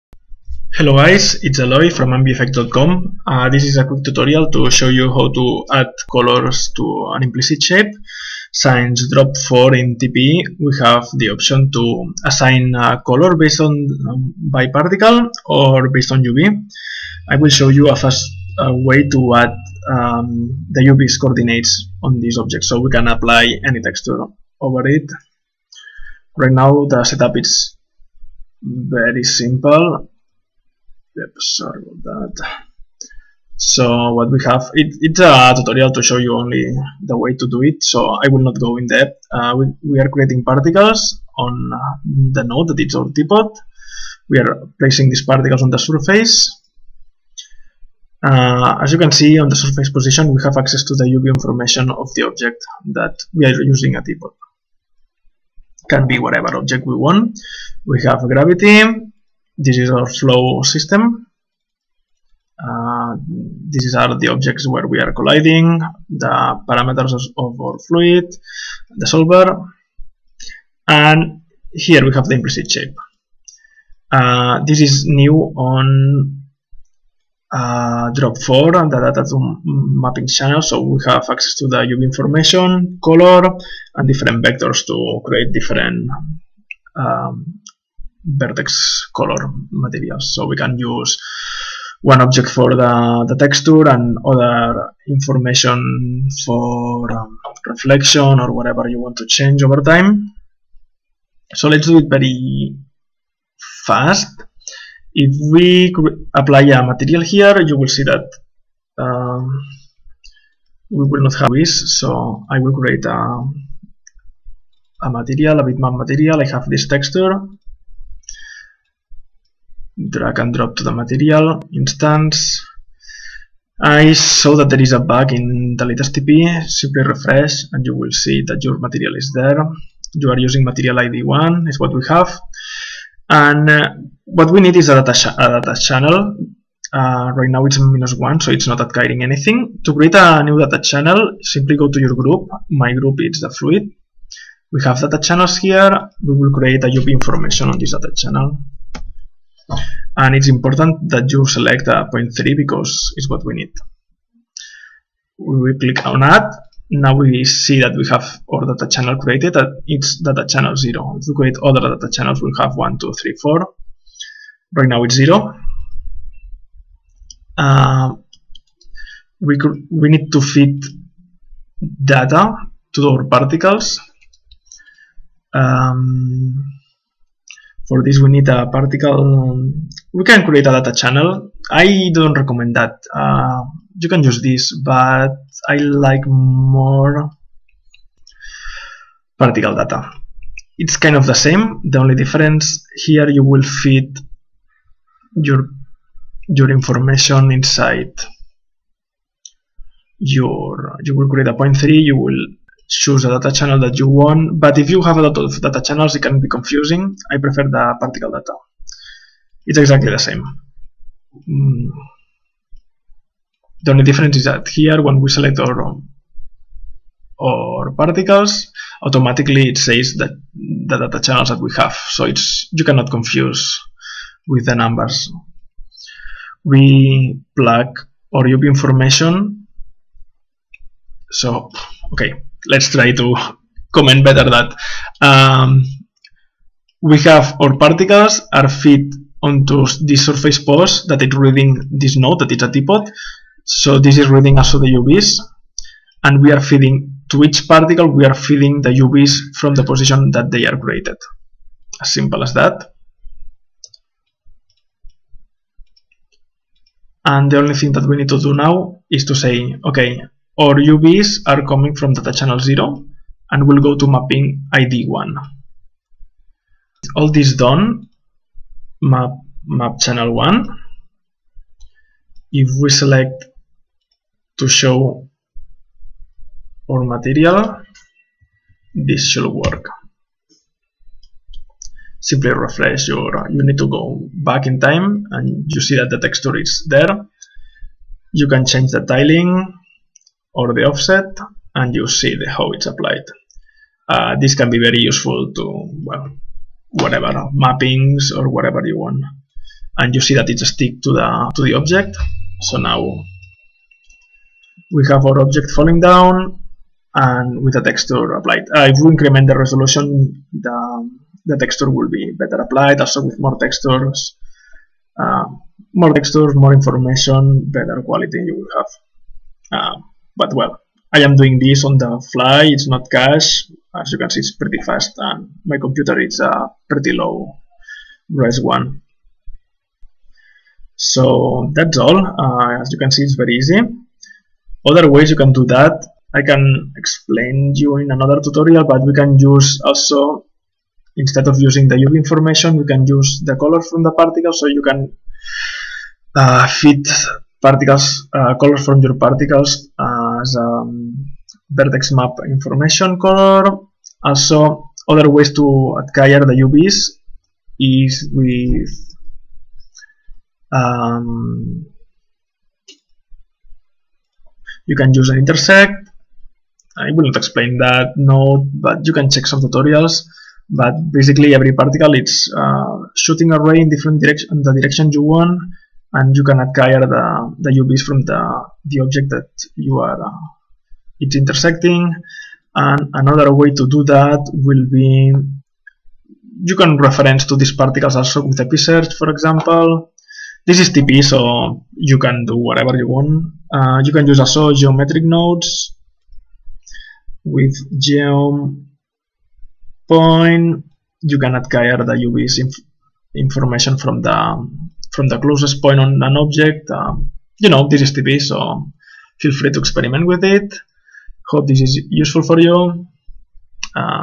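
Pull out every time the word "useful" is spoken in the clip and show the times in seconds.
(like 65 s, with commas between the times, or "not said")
294 s, 412 s.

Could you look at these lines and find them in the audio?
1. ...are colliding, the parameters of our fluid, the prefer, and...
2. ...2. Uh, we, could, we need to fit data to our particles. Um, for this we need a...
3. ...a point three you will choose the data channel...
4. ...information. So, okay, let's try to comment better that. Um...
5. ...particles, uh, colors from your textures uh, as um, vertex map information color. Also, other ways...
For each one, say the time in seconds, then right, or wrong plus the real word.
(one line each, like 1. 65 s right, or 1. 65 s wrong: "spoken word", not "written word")
1. 64 s wrong: "solver", not "prefer"
2. 165 s wrong: "0", not "2"
3. 201 s right
4. 228 s right
5. 347 s wrong: "particles", not "textures".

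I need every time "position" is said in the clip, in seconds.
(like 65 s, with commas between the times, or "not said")
49 s, 249 s.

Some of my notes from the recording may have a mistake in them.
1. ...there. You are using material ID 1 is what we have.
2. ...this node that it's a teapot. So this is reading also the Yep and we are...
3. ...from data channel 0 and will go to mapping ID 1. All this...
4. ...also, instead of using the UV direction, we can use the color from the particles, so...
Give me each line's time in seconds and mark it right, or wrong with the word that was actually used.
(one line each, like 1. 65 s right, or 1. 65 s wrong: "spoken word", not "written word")
1. 129 s right
2. 241 s wrong: "UVs", not "Yep"
3. 261 s right
4. 339 s wrong: "information", not "direction".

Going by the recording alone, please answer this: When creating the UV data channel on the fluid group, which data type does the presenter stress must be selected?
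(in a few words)
Point3.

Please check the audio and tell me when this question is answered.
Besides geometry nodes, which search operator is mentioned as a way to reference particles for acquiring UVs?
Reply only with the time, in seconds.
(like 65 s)
388 s.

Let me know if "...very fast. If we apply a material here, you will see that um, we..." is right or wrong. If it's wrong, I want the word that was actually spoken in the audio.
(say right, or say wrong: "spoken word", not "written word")
right.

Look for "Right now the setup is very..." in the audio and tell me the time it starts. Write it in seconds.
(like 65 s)
26 s.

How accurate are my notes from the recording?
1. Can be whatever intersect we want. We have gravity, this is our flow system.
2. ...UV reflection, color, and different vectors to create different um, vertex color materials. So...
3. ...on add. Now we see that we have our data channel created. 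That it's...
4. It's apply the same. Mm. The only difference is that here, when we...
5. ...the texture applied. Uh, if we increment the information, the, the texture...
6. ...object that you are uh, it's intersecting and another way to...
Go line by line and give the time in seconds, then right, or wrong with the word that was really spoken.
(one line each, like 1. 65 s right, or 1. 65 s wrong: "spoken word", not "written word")
1. 55 s wrong: "object", not "intersect"
2. 81 s wrong: "information", not "reflection"
3. 156 s right
4. 209 s wrong: "exactly", not "apply"
5. 307 s wrong: "resolution", not "information"
6. 379 s right.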